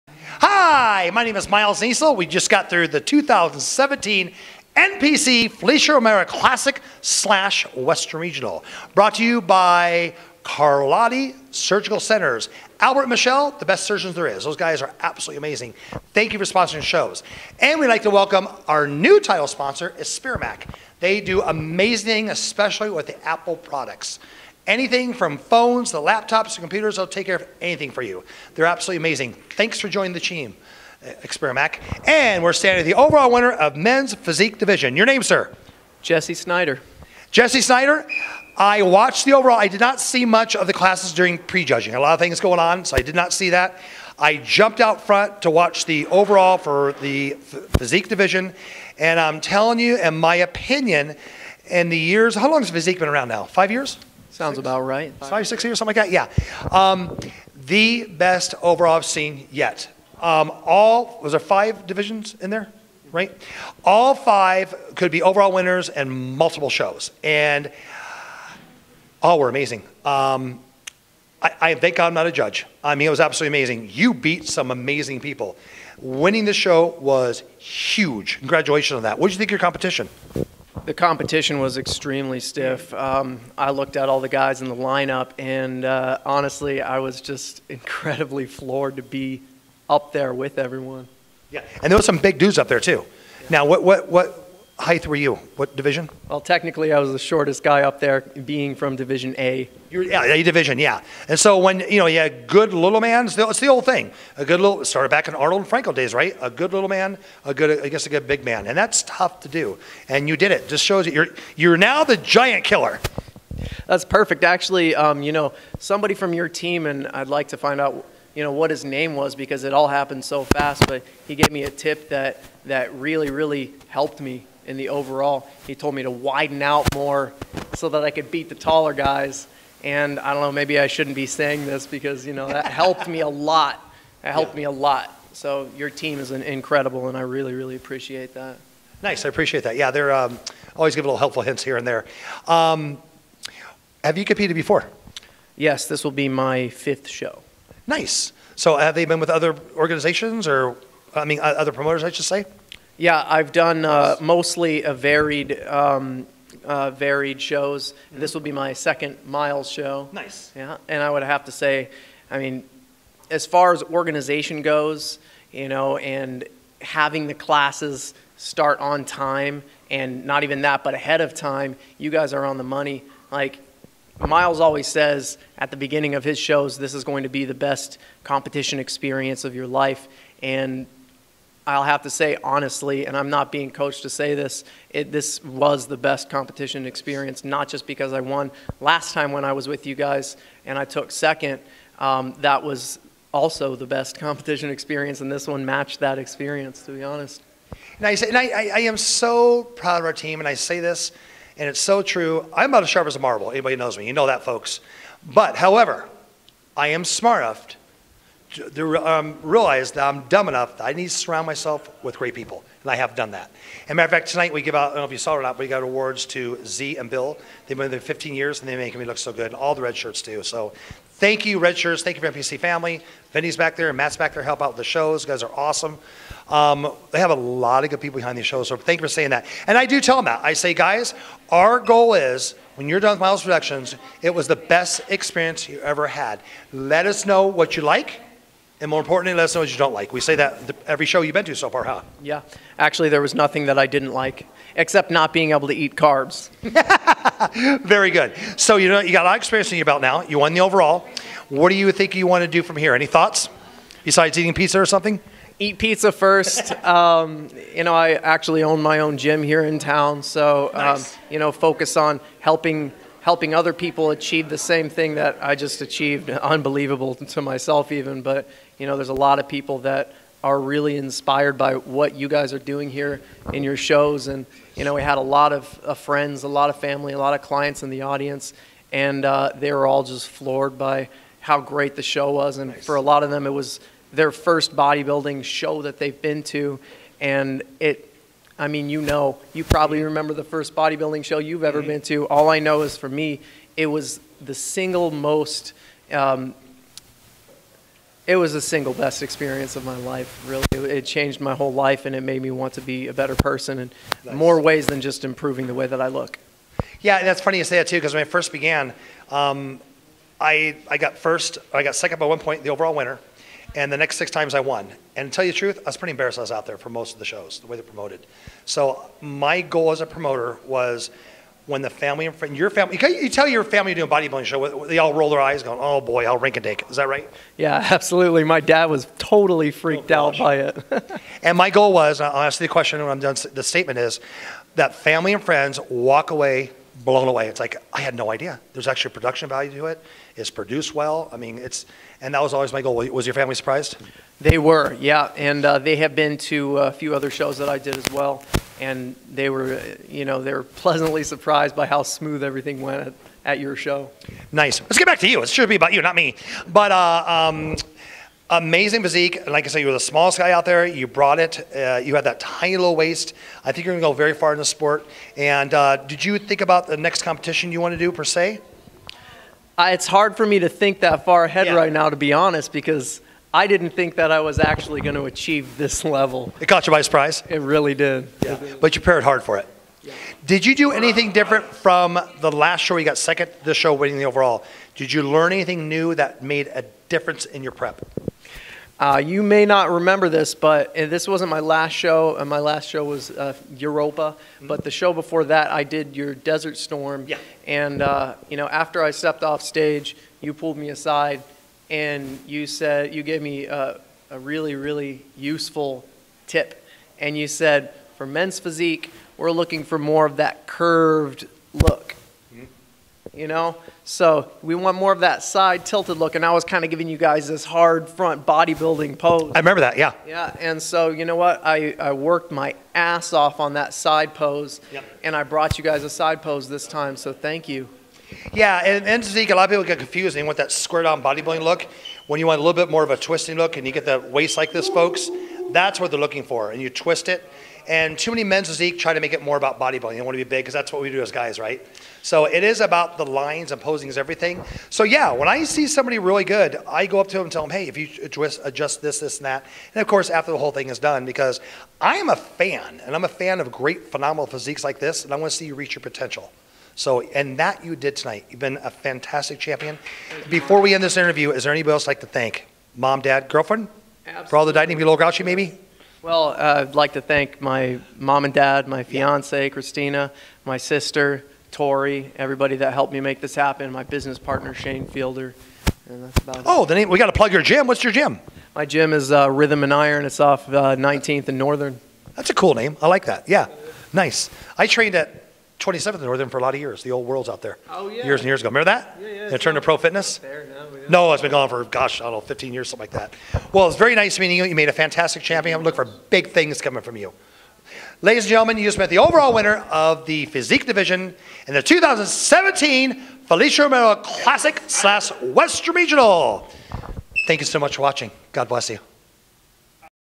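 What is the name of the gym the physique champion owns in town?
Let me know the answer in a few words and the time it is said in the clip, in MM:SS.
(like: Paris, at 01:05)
Rhythm and Iron, at 07:59.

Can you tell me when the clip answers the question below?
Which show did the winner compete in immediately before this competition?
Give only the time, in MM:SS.
06:33.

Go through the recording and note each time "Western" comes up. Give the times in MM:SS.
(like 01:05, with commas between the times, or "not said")
00:07, 08:25.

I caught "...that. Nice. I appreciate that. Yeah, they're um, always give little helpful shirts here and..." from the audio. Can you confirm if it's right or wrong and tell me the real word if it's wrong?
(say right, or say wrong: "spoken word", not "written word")
wrong: "hints", not "shirts".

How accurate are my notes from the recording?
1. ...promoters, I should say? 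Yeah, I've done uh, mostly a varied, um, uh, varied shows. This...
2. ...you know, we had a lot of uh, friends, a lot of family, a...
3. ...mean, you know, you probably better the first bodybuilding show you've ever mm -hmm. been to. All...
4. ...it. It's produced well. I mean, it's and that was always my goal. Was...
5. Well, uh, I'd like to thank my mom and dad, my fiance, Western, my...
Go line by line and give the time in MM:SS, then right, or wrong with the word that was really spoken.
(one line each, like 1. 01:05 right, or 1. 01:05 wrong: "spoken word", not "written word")
1. 02:31 right
2. 04:34 right
3. 04:48 wrong: "remember", not "better"
4. 05:39 right
5. 07:46 wrong: "Christina", not "Western".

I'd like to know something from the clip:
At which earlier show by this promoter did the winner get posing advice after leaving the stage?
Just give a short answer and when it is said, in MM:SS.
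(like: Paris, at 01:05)
Desert Storm, at 06:36.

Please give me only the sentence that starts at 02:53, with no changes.
Like Miles always says at the beginning of his shows, this is going to be the best competition experience of your life.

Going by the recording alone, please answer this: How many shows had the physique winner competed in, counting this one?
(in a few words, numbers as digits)
5.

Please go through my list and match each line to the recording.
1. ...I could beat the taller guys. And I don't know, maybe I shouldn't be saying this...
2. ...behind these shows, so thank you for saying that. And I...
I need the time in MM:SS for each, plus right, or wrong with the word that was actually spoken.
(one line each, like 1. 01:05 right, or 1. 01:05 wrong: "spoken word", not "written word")
1. 02:08 right
2. 03:48 right.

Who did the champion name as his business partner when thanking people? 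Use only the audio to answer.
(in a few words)
Shane Fielder.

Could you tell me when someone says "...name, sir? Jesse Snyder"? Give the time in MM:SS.
00:35.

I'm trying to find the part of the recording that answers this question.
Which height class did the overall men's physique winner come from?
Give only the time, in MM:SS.
01:38.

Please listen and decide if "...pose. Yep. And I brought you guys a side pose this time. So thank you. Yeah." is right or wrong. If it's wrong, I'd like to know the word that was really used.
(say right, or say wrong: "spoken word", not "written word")
right.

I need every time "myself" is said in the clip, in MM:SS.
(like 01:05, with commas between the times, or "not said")
03:31, 04:27.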